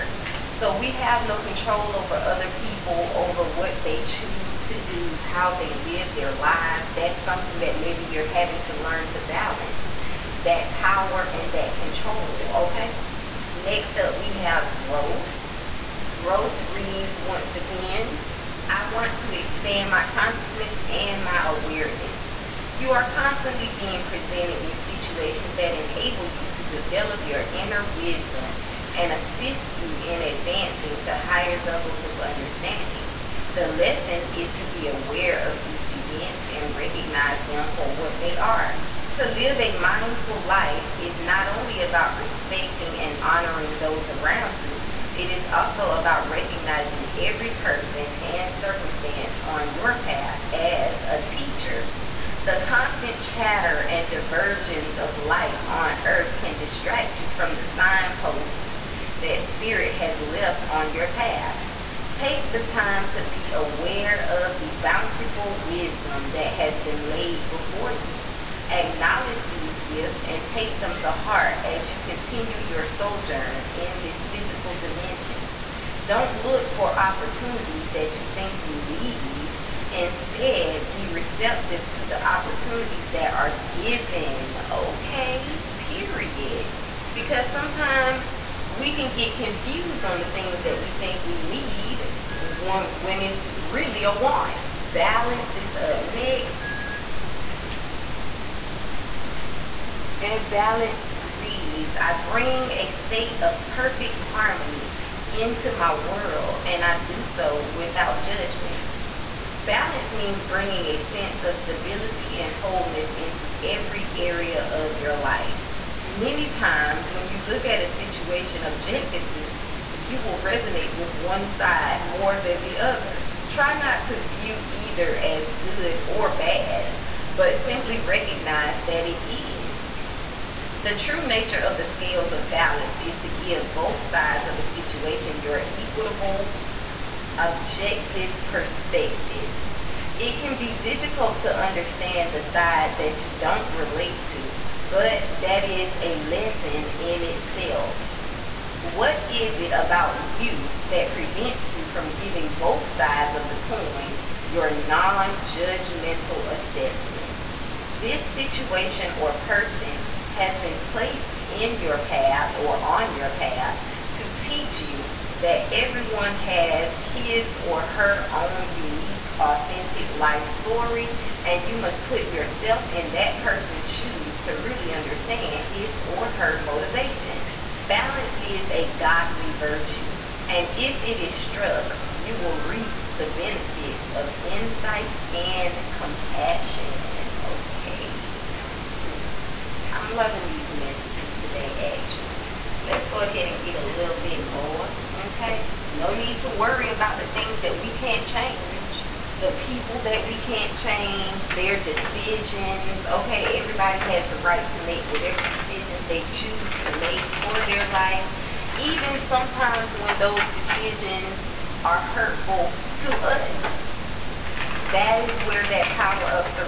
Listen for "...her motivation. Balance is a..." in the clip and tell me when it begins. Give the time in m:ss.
2:56.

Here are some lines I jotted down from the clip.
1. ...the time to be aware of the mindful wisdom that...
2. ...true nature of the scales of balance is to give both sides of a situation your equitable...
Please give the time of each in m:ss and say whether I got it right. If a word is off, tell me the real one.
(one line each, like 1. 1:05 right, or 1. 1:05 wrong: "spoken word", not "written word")
1. 1:02 wrong: "bountiful", not "mindful"
2. 2:10 right.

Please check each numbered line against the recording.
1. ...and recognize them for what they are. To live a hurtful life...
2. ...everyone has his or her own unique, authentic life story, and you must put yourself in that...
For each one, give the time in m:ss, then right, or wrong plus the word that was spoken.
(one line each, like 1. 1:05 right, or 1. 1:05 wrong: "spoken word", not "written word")
1. 0:36 wrong: "mindful", not "hurtful"
2. 2:45 right.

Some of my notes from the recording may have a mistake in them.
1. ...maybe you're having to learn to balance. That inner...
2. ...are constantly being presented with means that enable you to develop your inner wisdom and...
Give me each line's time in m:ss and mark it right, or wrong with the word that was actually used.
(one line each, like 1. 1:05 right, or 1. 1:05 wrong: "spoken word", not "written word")
1. 0:07 wrong: "power", not "inner"
2. 0:22 wrong: "situations", not "means".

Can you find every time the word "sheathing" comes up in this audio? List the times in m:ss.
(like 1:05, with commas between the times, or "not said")
not said.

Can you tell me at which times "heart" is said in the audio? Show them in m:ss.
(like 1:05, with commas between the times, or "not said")
1:11.